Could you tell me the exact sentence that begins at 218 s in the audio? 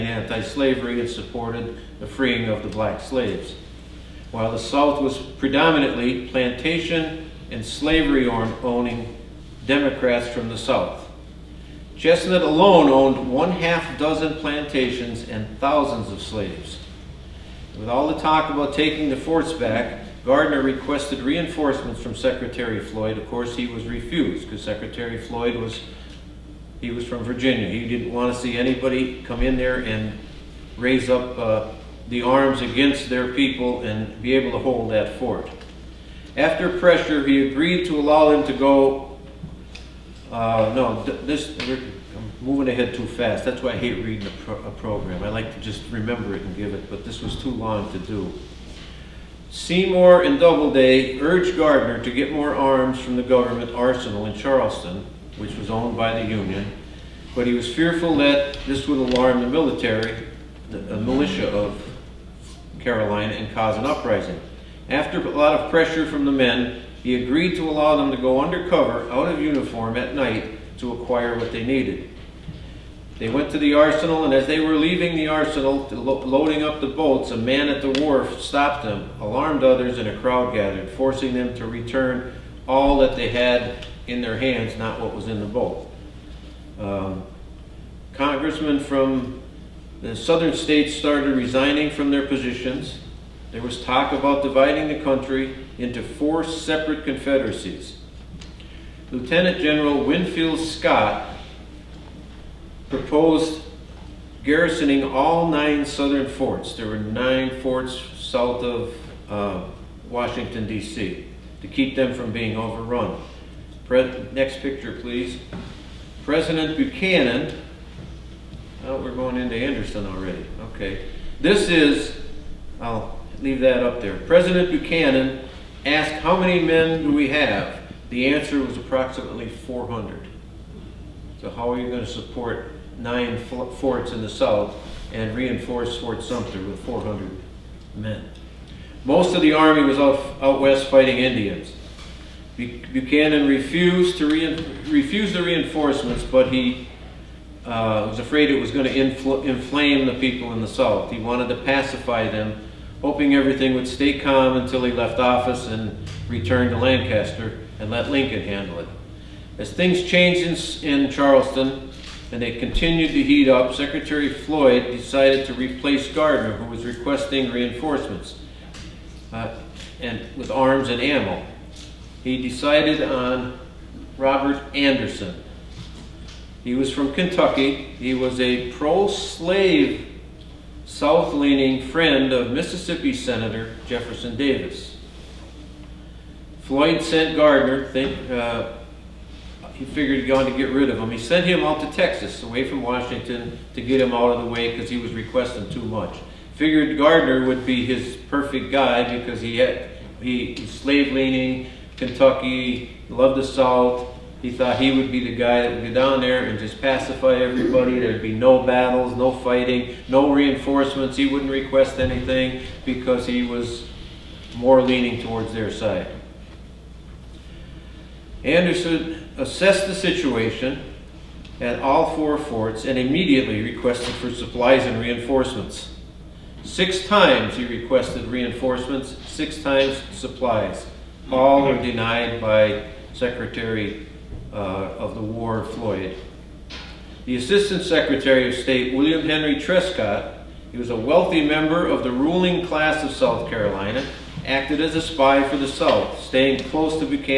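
Anderson assessed the situation at all four forts and immediately requested for supplies and reinforcements.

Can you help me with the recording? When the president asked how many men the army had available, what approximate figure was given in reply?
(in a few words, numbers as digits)
400.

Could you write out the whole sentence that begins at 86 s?
Um, congressmen from the southern states started resigning from their positions.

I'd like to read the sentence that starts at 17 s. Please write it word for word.
With all the talk about taking the forts back, Gardner requested reinforcements from Secretary Floyd.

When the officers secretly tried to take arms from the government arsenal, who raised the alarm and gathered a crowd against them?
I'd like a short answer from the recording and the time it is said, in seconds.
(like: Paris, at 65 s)
A man at the wharf, at 77 s.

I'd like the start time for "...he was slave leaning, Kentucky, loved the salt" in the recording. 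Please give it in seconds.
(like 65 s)
200 s.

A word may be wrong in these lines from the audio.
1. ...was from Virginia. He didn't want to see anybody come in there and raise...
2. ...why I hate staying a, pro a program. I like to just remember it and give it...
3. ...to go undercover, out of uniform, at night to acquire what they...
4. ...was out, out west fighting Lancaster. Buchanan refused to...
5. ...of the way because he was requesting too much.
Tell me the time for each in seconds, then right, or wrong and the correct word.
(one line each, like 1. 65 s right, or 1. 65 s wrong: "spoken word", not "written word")
1. 26 s right
2. 43 s wrong: "reading", not "staying"
3. 68 s right
4. 139 s wrong: "Indians", not "Lancaster"
5. 194 s right.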